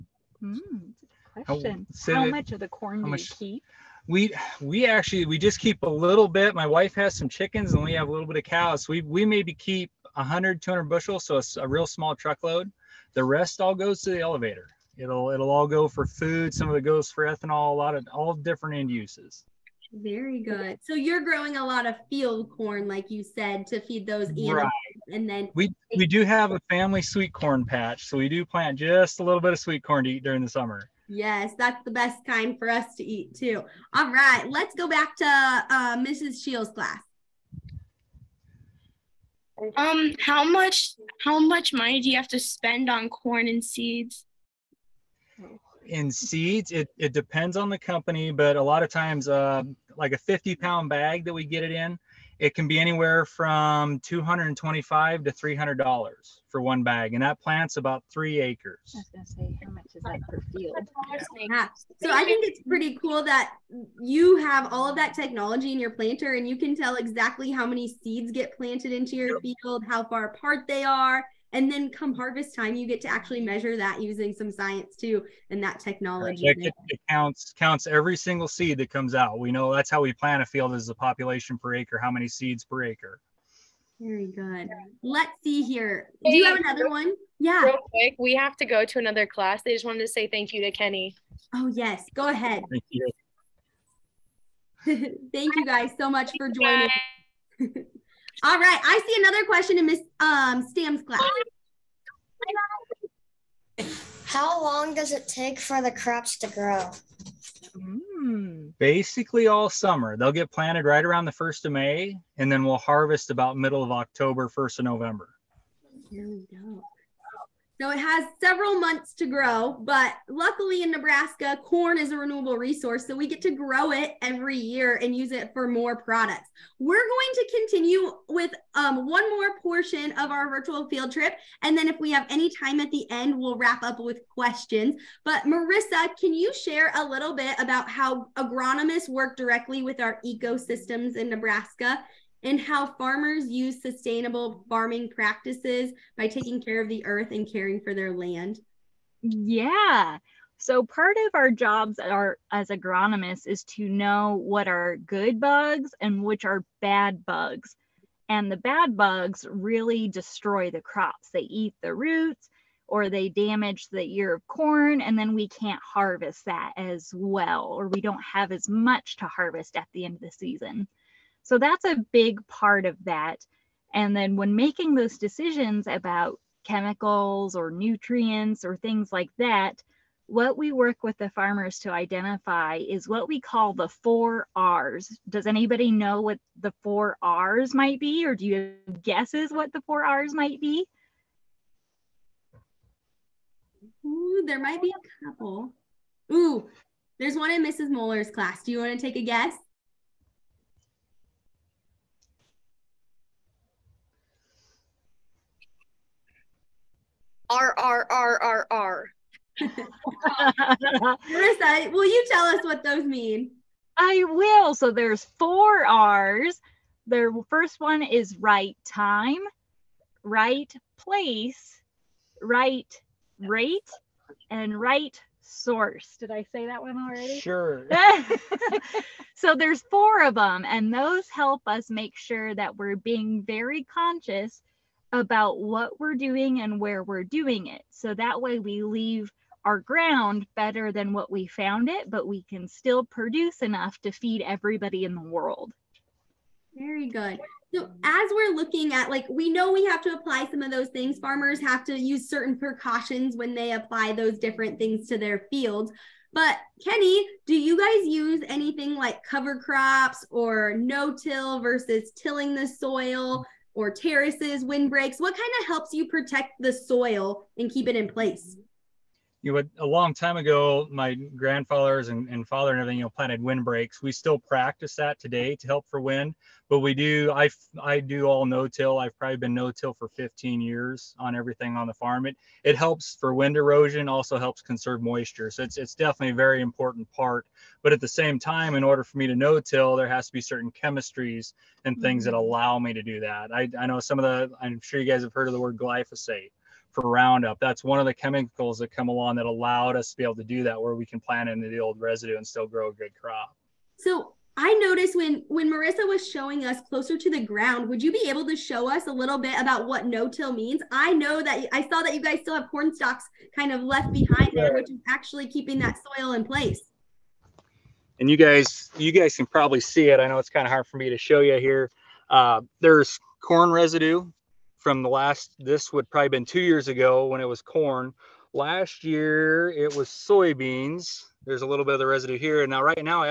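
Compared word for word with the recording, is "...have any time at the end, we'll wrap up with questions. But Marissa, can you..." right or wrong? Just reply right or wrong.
right.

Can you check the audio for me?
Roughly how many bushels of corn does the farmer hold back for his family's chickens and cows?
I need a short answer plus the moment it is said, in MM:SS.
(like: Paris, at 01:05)
100-200 bushels, at 00:10.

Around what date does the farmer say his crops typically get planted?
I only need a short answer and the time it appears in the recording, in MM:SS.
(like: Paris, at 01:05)
1st of May, at 01:51.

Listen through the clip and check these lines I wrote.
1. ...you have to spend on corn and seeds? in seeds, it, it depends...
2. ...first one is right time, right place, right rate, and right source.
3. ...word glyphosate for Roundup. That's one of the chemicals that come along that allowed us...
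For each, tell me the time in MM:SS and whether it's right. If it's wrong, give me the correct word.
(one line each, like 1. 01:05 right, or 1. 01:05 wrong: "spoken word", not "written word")
1. 00:42 right
2. 03:37 right
3. 04:55 right.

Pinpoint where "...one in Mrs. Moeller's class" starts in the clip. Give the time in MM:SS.
03:17.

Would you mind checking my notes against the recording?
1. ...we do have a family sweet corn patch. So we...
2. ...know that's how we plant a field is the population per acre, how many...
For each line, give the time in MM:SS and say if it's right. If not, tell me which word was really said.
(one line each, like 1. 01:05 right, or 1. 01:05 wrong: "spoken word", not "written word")
1. 00:25 right
2. 01:19 right.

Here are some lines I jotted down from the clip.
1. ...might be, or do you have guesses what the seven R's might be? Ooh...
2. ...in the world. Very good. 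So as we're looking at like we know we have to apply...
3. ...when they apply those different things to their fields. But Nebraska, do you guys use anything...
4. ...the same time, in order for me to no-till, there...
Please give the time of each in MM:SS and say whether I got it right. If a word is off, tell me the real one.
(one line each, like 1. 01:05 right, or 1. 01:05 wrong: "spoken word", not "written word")
1. 03:07 wrong: "four", not "seven"
2. 04:05 right
3. 04:13 wrong: "Kenny", not "Nebraska"
4. 04:48 right.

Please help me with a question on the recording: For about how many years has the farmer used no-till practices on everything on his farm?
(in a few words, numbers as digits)
15 years.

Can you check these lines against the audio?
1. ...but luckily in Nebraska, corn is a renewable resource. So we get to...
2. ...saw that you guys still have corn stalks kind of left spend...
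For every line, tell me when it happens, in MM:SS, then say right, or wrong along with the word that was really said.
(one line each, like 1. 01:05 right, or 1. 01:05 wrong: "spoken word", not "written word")
1. 01:59 right
2. 05:11 wrong: "behind", not "spend".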